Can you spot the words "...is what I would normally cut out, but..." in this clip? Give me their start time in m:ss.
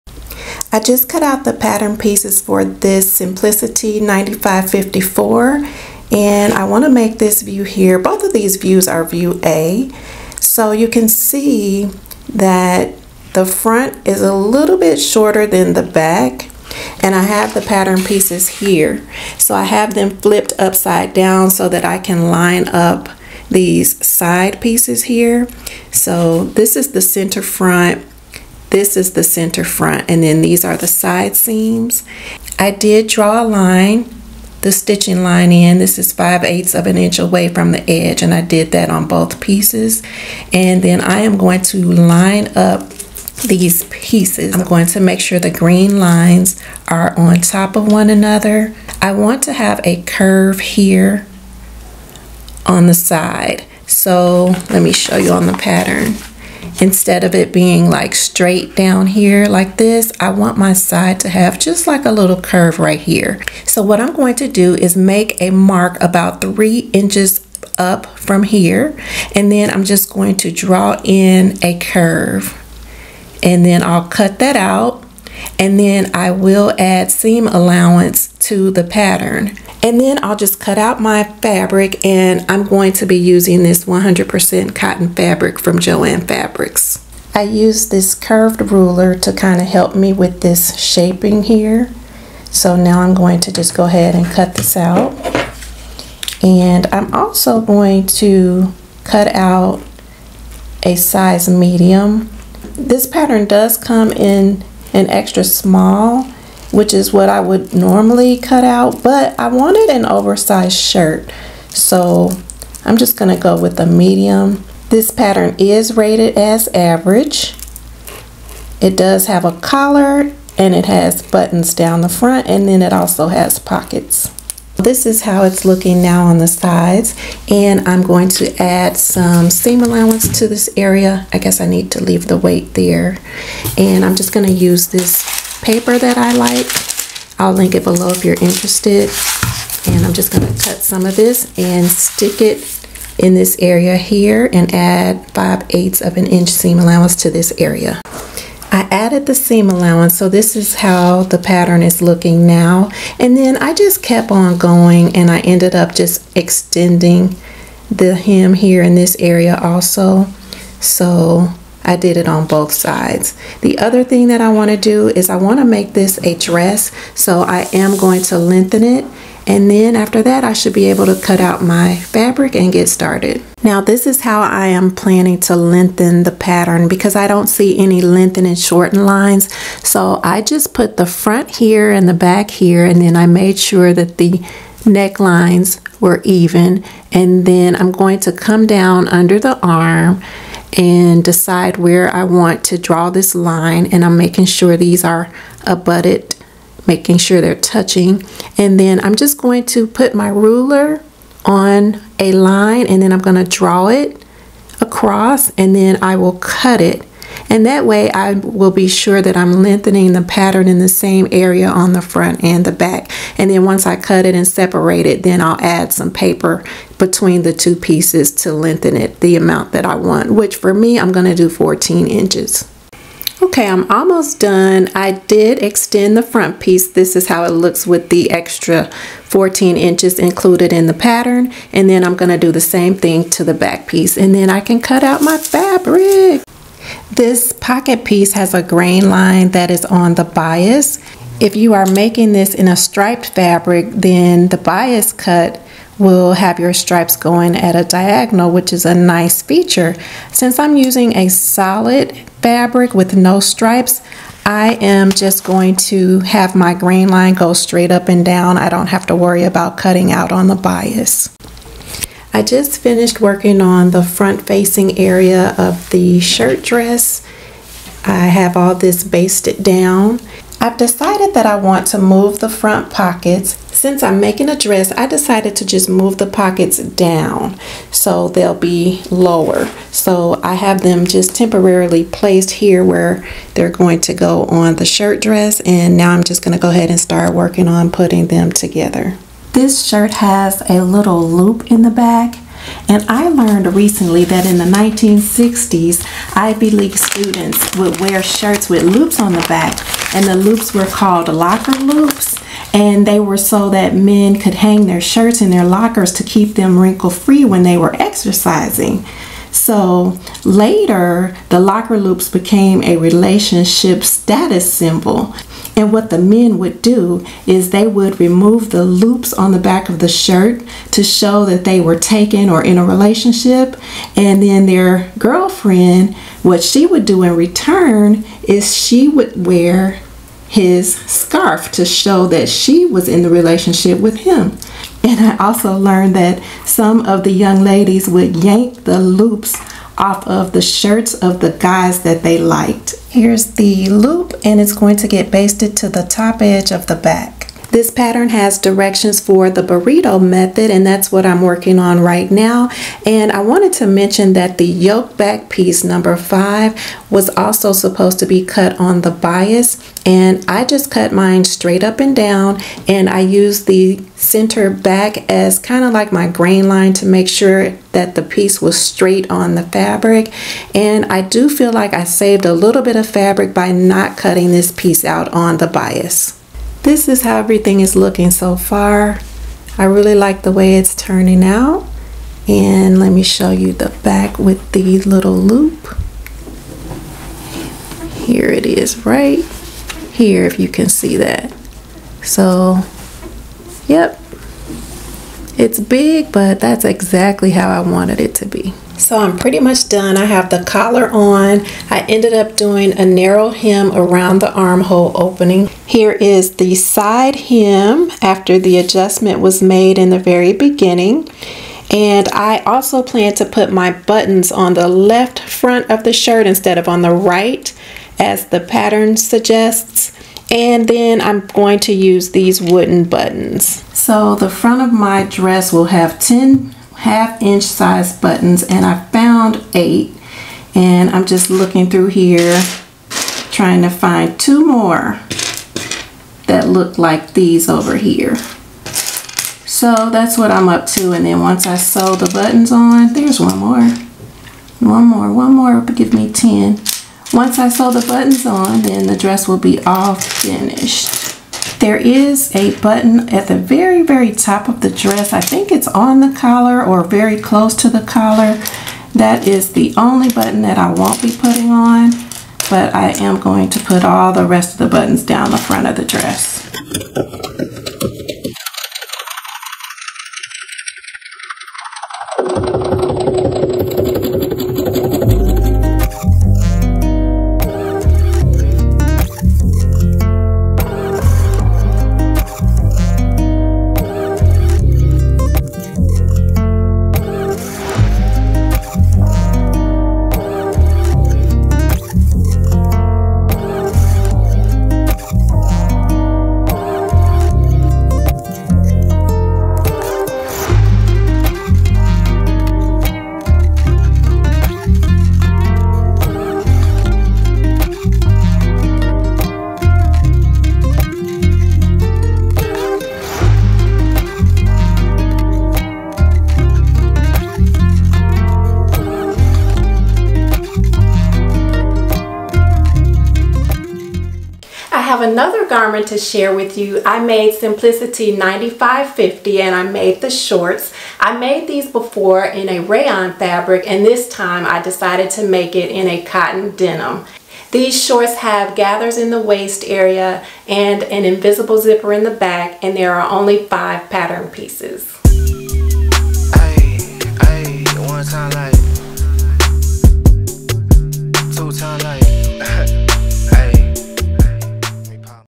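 1:46.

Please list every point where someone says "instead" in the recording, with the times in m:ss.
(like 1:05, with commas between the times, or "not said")
0:56, 6:56.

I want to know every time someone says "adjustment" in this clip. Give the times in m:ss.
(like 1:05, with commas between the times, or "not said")
6:48.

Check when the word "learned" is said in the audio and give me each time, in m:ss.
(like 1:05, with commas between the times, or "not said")
4:53, 5:35.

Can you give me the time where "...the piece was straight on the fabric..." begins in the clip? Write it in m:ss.
6:08.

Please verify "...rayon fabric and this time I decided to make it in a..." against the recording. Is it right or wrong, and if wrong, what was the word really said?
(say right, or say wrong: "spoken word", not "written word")
right.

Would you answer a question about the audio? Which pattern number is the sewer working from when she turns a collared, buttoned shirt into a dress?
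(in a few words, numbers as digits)
Simplicity 9554.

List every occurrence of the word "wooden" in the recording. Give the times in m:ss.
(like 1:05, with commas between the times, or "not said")
7:02.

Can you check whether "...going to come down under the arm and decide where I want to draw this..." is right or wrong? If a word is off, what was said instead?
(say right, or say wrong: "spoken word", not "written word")
right.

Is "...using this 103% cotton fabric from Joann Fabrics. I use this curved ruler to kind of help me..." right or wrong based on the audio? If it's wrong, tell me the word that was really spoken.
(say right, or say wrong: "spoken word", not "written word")
wrong: "100", not "103".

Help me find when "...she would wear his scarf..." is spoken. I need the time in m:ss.
5:28.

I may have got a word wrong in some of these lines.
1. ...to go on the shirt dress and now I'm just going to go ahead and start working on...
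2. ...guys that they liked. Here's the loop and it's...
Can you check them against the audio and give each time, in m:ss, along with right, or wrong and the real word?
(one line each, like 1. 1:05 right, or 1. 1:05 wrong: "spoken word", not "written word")
1. 4:44 right
2. 5:41 right.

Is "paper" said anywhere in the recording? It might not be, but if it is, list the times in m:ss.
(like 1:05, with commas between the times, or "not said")
2:15, 3:36.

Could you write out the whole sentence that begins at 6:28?
Here it is right here if you can see that.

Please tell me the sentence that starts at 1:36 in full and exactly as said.
And I'm also going to cut out a size medium.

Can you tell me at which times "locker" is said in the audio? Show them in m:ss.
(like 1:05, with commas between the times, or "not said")
5:01, 5:05, 5:11.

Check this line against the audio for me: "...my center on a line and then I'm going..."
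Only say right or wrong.
wrong.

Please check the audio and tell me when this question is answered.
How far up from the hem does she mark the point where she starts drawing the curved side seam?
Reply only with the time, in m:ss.
1:06.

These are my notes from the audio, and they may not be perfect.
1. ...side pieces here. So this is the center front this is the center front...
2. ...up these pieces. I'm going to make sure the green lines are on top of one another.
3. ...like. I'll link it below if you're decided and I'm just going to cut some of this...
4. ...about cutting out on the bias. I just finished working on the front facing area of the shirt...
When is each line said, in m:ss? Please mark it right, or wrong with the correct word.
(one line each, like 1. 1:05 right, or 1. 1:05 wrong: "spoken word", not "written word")
1. 0:24 right
2. 0:42 right
3. 2:16 wrong: "interested", not "decided"
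4. 4:19 right.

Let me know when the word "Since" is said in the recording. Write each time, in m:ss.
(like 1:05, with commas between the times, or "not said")
4:10, 4:33.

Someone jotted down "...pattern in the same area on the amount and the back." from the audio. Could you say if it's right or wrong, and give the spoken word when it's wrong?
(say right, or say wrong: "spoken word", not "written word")
wrong: "front", not "amount".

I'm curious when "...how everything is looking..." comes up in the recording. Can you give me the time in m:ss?
6:17.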